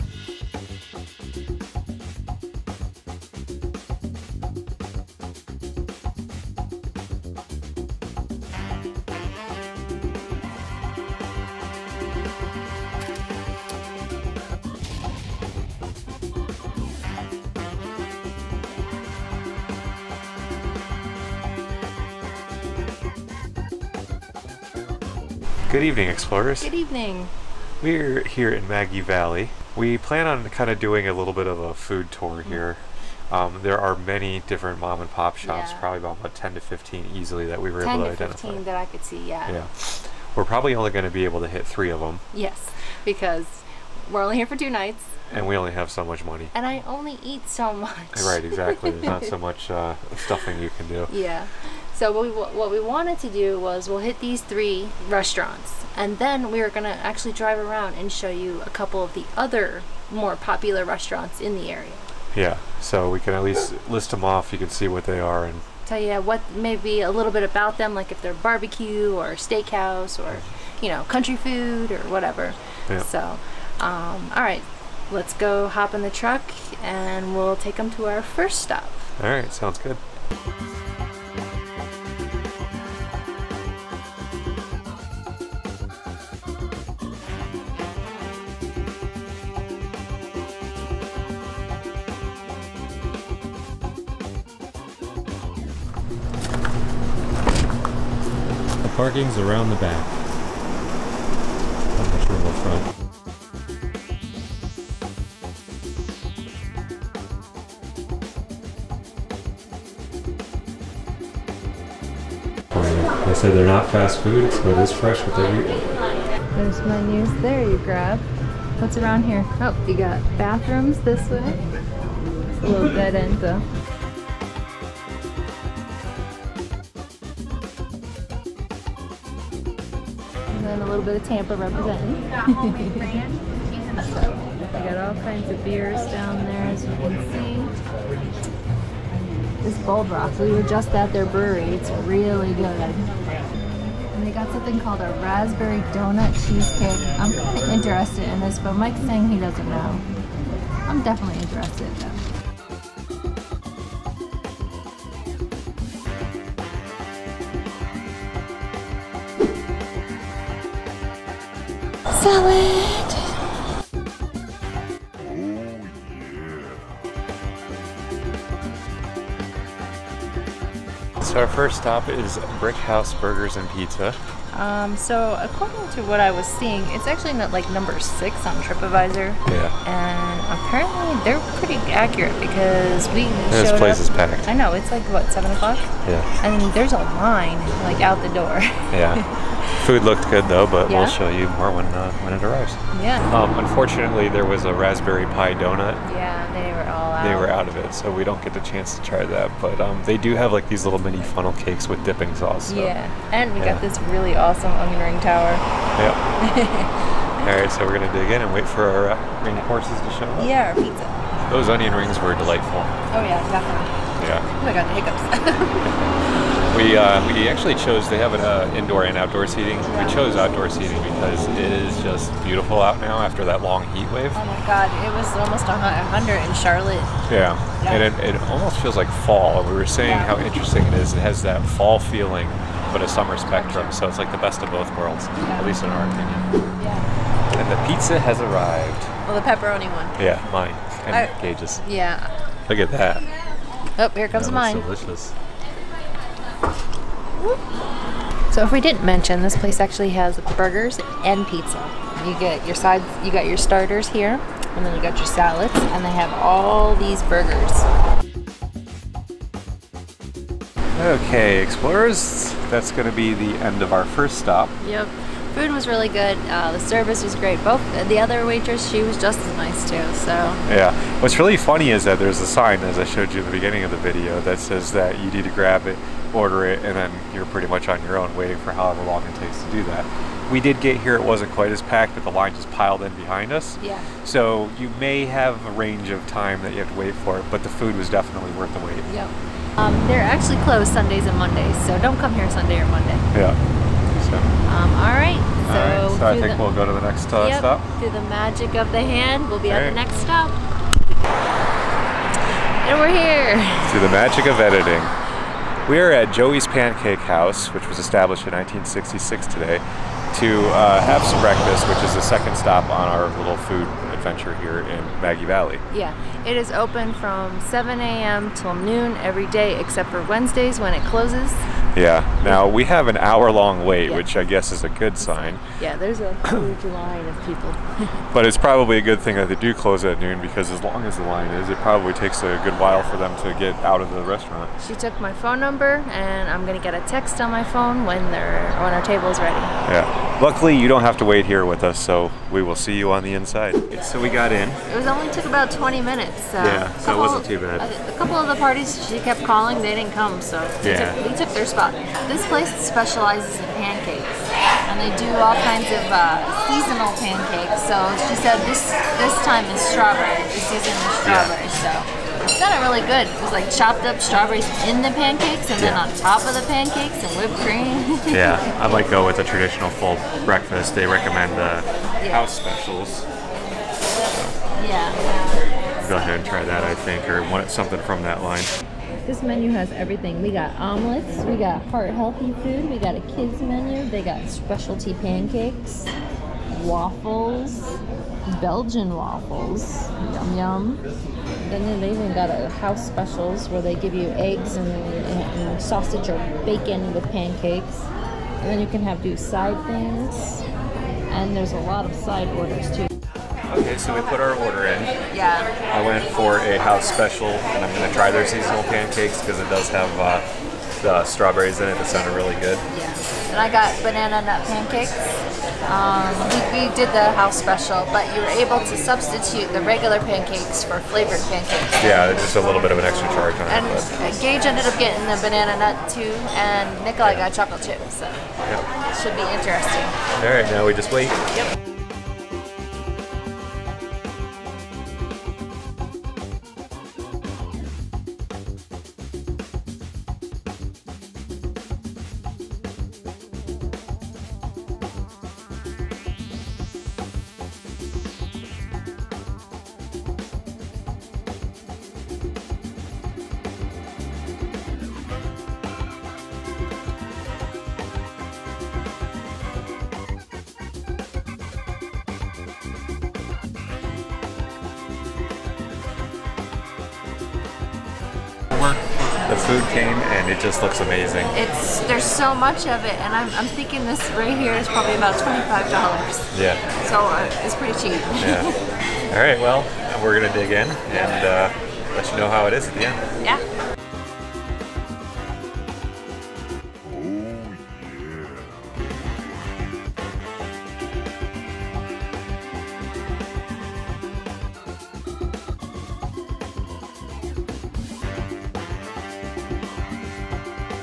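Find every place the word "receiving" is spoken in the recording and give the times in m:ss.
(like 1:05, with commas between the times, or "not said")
not said.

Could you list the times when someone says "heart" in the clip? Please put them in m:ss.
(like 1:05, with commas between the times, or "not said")
6:21.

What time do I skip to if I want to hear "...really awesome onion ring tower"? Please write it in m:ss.
3:24.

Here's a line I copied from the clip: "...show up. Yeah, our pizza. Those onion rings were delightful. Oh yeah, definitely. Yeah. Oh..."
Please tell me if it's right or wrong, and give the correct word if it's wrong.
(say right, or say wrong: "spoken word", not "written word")
right.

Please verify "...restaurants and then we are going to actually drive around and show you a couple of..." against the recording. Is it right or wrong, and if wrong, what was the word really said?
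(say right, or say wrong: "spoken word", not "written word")
right.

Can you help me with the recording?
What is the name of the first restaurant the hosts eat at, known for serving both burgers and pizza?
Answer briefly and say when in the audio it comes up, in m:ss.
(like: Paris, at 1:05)
Brickhouse Burgers and Pizza, at 2:52.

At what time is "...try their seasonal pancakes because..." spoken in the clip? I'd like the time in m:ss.
6:48.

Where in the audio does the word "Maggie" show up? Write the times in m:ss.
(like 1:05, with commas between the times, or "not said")
0:28, 5:15.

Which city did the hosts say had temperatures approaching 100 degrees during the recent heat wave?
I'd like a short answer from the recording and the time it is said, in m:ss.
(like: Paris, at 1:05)
Charlotte, at 3:46.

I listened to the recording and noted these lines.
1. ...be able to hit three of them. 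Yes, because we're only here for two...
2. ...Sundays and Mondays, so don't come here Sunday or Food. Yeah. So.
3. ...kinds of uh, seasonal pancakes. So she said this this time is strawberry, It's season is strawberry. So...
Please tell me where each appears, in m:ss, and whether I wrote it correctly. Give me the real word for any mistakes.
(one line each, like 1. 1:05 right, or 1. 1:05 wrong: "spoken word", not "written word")
1. 0:41 right
2. 4:50 wrong: "Monday", not "Food"
3. 5:55 right.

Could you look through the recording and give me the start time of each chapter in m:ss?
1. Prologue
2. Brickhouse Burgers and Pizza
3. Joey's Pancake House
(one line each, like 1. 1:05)
1. 0:25
2. 1:35
3. 5:01.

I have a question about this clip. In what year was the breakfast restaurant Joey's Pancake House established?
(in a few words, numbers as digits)
1966.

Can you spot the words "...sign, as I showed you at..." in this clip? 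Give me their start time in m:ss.
4:32.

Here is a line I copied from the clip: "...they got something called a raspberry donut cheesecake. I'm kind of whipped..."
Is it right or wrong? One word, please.
wrong.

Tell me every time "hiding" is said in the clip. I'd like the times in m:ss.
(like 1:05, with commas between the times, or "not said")
not said.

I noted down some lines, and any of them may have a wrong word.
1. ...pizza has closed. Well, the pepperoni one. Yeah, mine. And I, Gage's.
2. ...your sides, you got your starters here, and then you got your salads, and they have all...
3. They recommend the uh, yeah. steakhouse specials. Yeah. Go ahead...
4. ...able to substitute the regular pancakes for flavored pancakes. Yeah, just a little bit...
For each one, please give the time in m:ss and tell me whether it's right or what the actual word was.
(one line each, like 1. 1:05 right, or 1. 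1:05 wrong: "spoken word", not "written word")
1. 3:57 wrong: "arrived", not "closed"
2. 4:12 right
3. 6:10 wrong: "house", not "steakhouse"
4. 6:58 right.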